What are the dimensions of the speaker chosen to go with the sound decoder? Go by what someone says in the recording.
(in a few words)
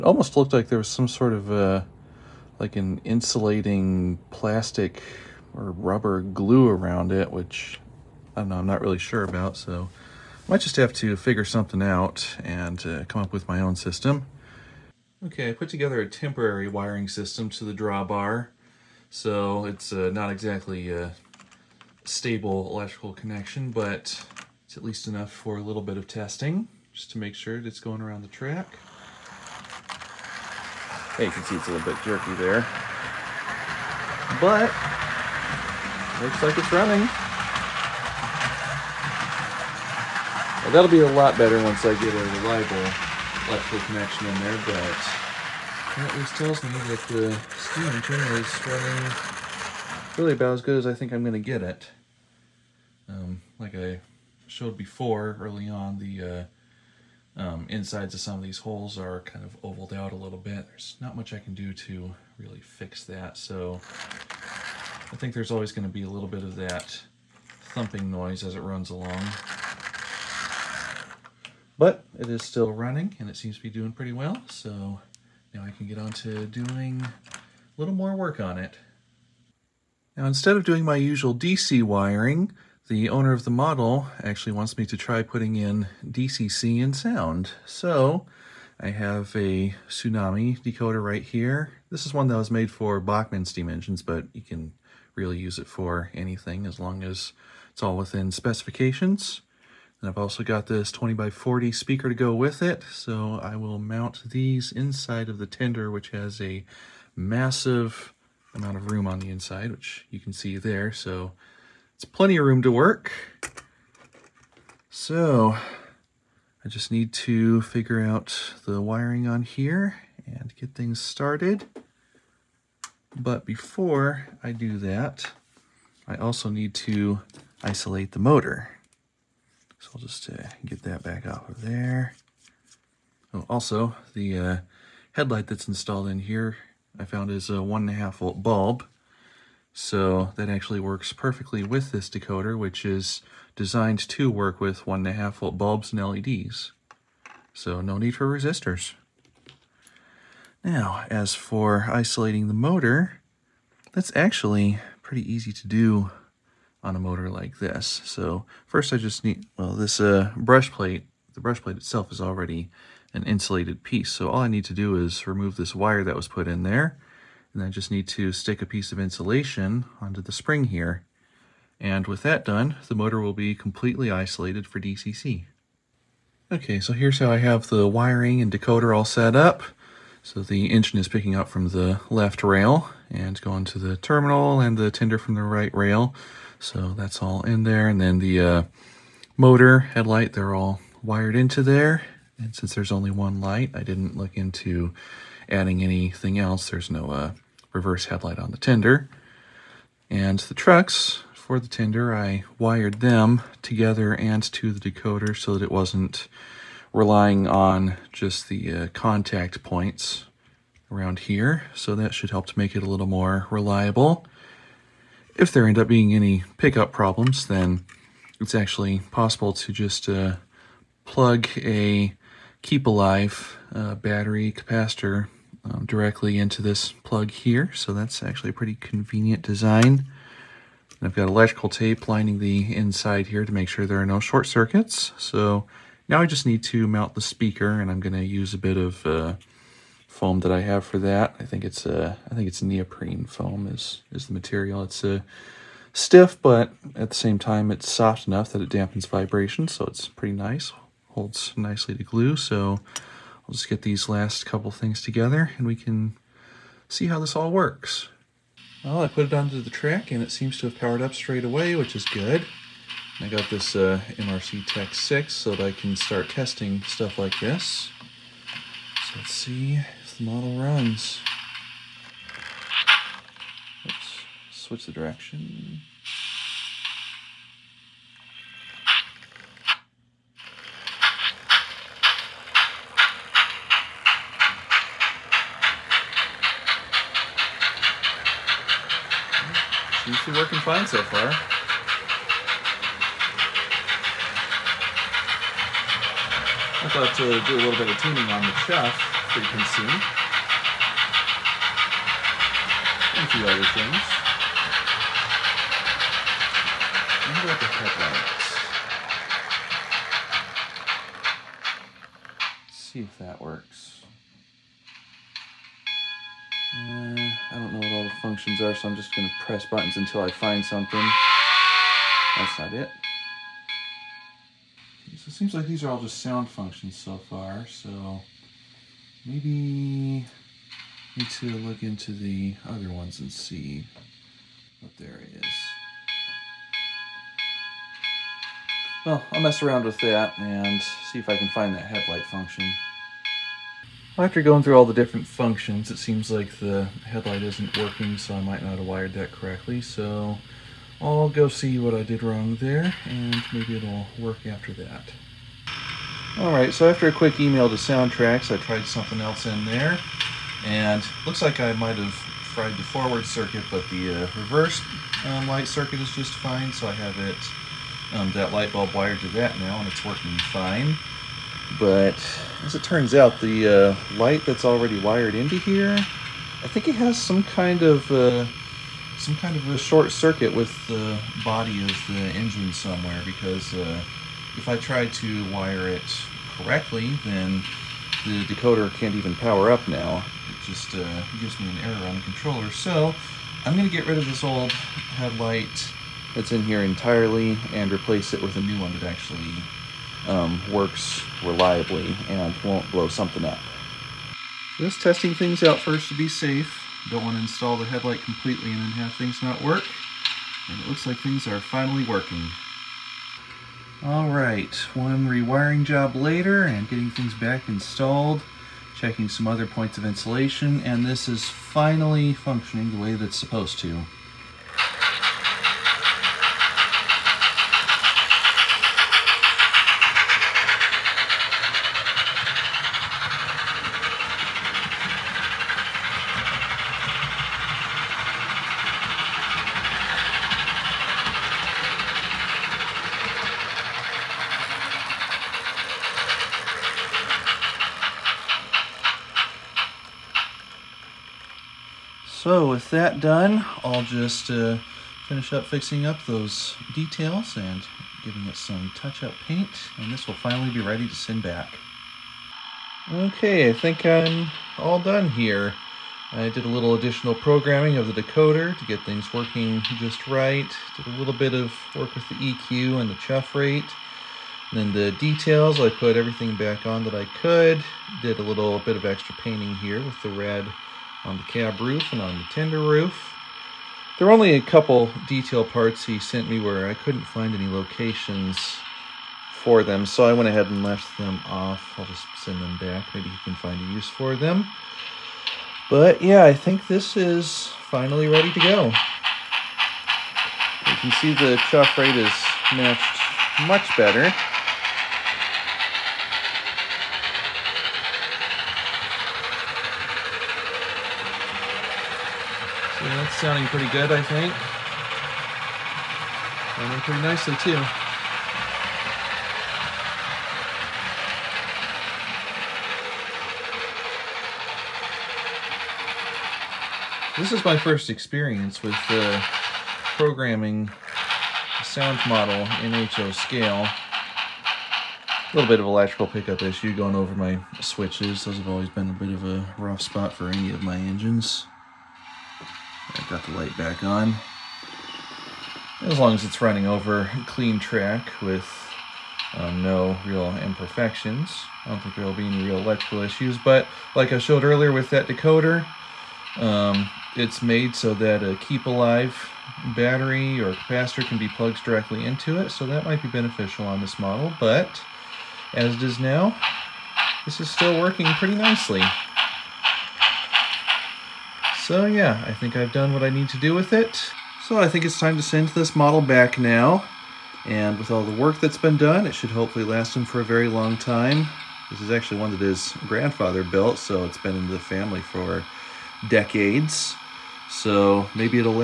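20 by 40.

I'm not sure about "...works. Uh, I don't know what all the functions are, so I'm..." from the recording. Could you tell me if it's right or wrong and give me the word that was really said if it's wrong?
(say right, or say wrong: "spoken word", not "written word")
right.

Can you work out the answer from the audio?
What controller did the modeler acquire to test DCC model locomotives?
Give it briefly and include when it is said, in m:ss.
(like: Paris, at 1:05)
MRC Tech 6, at 4:24.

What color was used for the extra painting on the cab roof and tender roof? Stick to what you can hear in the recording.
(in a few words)
Red.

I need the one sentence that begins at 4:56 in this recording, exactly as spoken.
I thought to do a little bit of tuning on the chuff frequency, and a few other things.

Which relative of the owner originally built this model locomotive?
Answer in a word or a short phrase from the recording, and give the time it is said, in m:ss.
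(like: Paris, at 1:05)
His grandfather, at 9:42.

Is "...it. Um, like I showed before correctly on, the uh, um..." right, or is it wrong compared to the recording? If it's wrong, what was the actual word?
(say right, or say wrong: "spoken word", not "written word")
wrong: "early", not "correctly".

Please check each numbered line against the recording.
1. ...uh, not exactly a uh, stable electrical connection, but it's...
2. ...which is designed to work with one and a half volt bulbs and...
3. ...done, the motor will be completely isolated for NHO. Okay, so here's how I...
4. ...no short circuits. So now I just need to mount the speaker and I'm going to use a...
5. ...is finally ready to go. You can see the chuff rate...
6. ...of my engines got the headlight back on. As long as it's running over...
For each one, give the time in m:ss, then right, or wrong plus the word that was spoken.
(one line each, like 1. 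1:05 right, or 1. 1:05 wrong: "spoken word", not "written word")
1. 0:19 right
2. 2:22 right
3. 2:52 wrong: "DCC", not "NHO"
4. 3:54 right
5. 8:17 right
6. 9:00 wrong: "light", not "headlight".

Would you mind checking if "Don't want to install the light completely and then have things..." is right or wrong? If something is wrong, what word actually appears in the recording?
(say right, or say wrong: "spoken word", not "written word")
wrong: "headlight", not "light".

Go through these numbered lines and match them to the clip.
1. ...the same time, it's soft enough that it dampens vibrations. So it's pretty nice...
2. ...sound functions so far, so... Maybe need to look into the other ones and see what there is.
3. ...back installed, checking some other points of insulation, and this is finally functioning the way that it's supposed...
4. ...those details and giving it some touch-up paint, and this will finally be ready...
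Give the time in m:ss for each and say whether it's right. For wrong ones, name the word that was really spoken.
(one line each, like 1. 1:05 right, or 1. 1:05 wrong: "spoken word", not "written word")
1. 4:07 right
2. 5:26 right
3. 6:57 right
4. 7:36 right.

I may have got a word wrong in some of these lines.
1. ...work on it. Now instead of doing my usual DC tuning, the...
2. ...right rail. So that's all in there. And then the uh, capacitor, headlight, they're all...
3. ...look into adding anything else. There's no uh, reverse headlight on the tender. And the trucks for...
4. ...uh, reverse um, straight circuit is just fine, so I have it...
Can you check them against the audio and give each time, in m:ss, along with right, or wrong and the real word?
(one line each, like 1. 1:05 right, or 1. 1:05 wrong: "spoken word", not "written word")
1. 1:18 wrong: "wiring", not "tuning"
2. 3:05 wrong: "motor", not "capacitor"
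3. 3:14 right
4. 6:04 wrong: "light", not "straight".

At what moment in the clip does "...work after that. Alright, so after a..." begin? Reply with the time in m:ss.
5:54.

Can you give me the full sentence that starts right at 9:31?
So yeah, I think I've done what I need to do with it.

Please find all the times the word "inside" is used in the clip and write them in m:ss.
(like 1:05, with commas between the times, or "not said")
0:57, 1:44, 1:49, 3:52.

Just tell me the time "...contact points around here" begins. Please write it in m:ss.
3:28.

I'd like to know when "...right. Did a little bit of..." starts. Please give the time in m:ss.
7:50.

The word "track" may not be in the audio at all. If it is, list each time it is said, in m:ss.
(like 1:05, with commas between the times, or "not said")
0:28, 4:19, 9:07.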